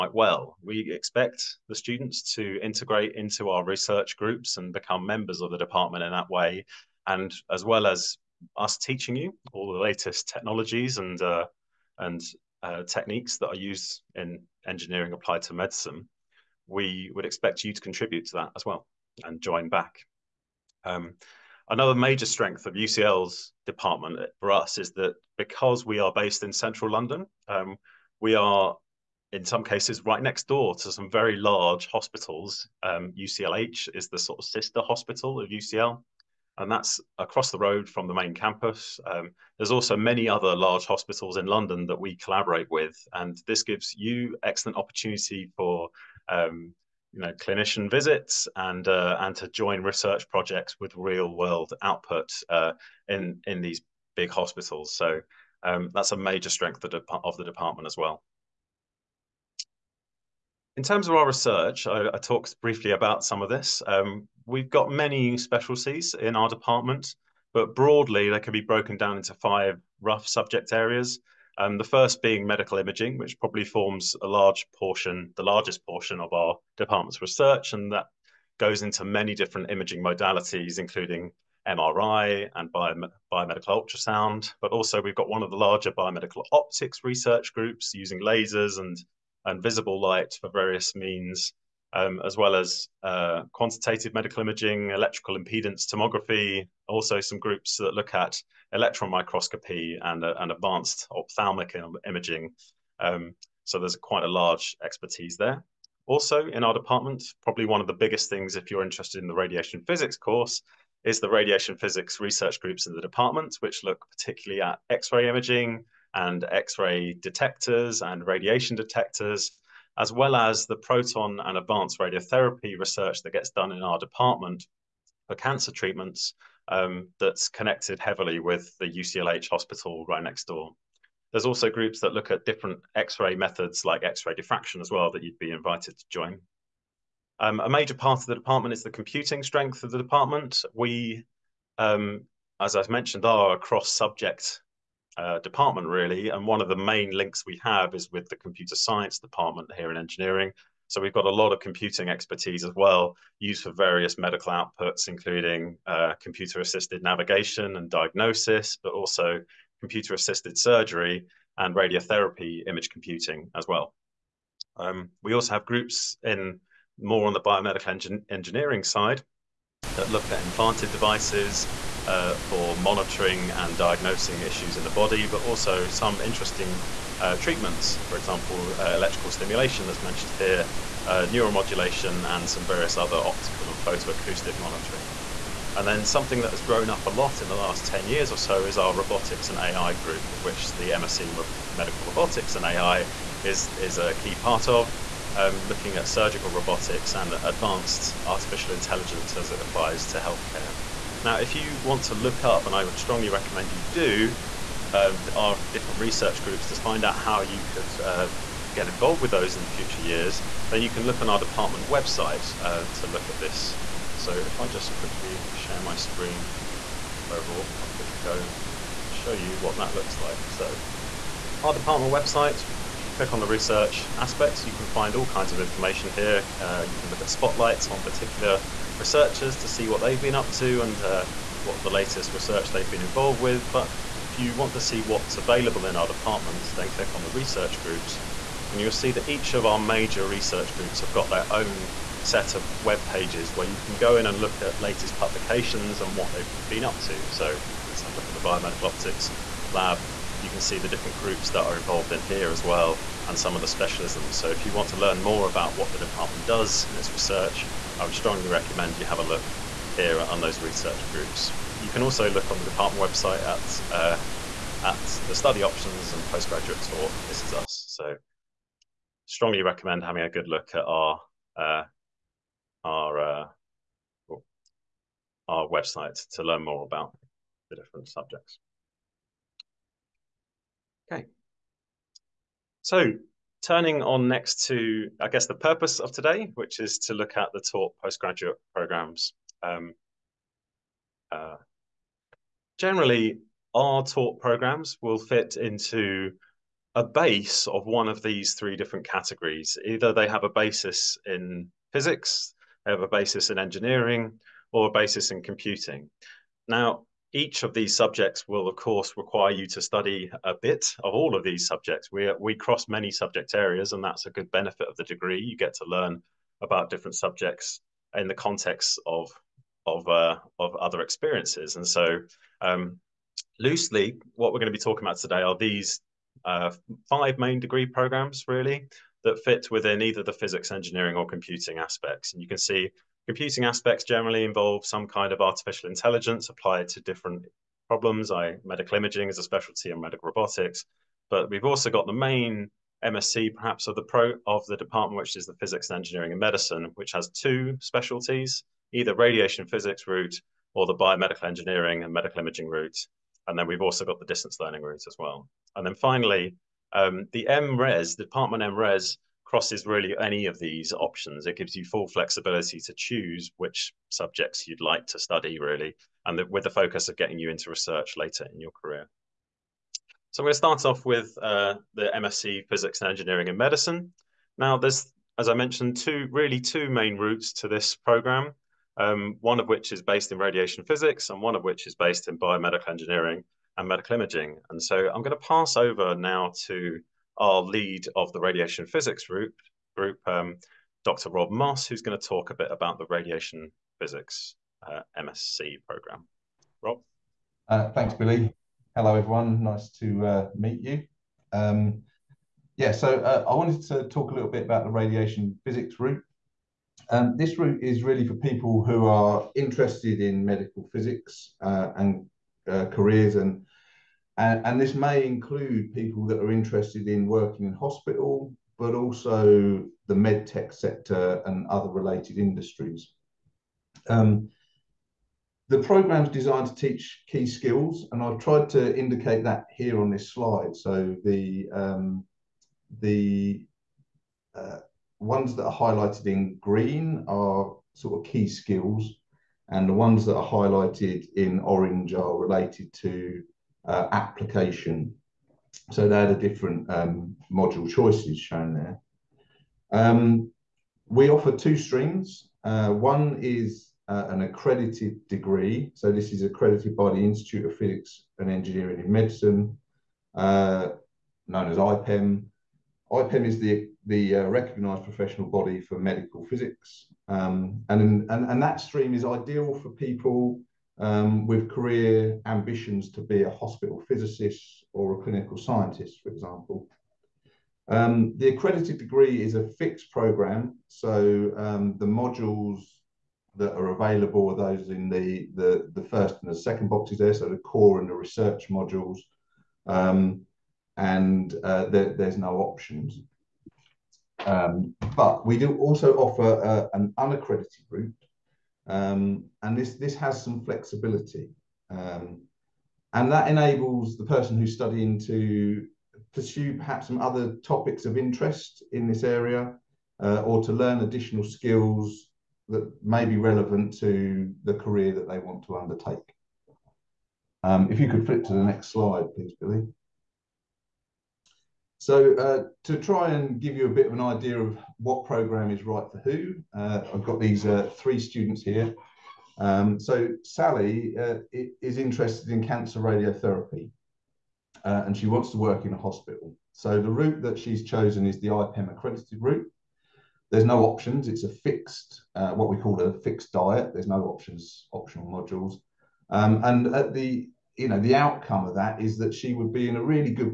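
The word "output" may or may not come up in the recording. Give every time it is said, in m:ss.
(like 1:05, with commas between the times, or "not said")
0:51, 2:34.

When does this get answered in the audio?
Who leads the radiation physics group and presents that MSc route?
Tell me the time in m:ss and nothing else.
6:31.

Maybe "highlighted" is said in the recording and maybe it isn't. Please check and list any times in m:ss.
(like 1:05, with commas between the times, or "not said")
7:15, 7:20.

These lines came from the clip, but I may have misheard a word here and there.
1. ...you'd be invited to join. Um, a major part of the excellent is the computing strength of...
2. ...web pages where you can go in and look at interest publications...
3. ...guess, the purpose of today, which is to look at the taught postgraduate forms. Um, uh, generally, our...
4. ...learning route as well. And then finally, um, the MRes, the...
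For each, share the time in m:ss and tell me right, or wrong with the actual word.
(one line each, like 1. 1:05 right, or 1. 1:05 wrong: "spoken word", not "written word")
1. 2:15 wrong: "department", not "excellent"
2. 4:02 wrong: "latest", not "interest"
3. 4:45 wrong: "programs", not "forms"
4. 5:54 right.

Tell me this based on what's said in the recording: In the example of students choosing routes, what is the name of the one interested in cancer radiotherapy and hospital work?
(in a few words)
Sally.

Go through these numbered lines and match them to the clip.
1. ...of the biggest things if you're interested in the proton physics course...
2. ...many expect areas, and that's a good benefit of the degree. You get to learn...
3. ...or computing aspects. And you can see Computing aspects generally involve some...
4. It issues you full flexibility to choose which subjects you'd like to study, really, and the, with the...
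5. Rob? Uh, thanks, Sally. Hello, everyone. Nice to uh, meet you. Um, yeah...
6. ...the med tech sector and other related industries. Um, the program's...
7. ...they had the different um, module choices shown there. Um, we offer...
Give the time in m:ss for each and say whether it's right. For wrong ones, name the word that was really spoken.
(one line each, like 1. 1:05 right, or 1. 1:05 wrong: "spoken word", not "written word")
1. 1:47 wrong: "radiation", not "proton"
2. 5:12 wrong: "subject", not "expect"
3. 5:31 right
4. 6:01 wrong: "gives", not "issues"
5. 6:36 wrong: "Billy", not "Sally"
6. 7:00 right
7. 7:26 right.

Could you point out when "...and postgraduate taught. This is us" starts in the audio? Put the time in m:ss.
4:26.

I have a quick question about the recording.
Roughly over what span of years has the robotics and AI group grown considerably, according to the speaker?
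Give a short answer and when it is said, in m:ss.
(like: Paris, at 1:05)
10 years, at 3:07.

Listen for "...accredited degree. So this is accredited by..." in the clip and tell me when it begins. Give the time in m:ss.
7:34.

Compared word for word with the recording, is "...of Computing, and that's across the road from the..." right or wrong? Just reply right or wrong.
wrong.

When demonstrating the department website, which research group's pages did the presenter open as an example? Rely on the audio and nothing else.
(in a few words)
biomedical optics lab.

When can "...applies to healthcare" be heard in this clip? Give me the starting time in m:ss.
3:19.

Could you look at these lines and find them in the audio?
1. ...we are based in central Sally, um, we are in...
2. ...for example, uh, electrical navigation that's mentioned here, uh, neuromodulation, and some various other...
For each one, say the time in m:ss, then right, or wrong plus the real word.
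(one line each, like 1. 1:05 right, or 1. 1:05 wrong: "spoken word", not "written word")
1. 0:25 wrong: "London", not "Sally"
2. 2:58 wrong: "stimulation", not "navigation".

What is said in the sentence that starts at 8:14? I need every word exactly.
Um, but we do also offer uh, an unaccredited route, um, and this, this has some flexibility.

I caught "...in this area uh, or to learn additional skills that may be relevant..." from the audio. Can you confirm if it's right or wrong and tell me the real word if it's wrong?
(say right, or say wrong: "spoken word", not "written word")
right.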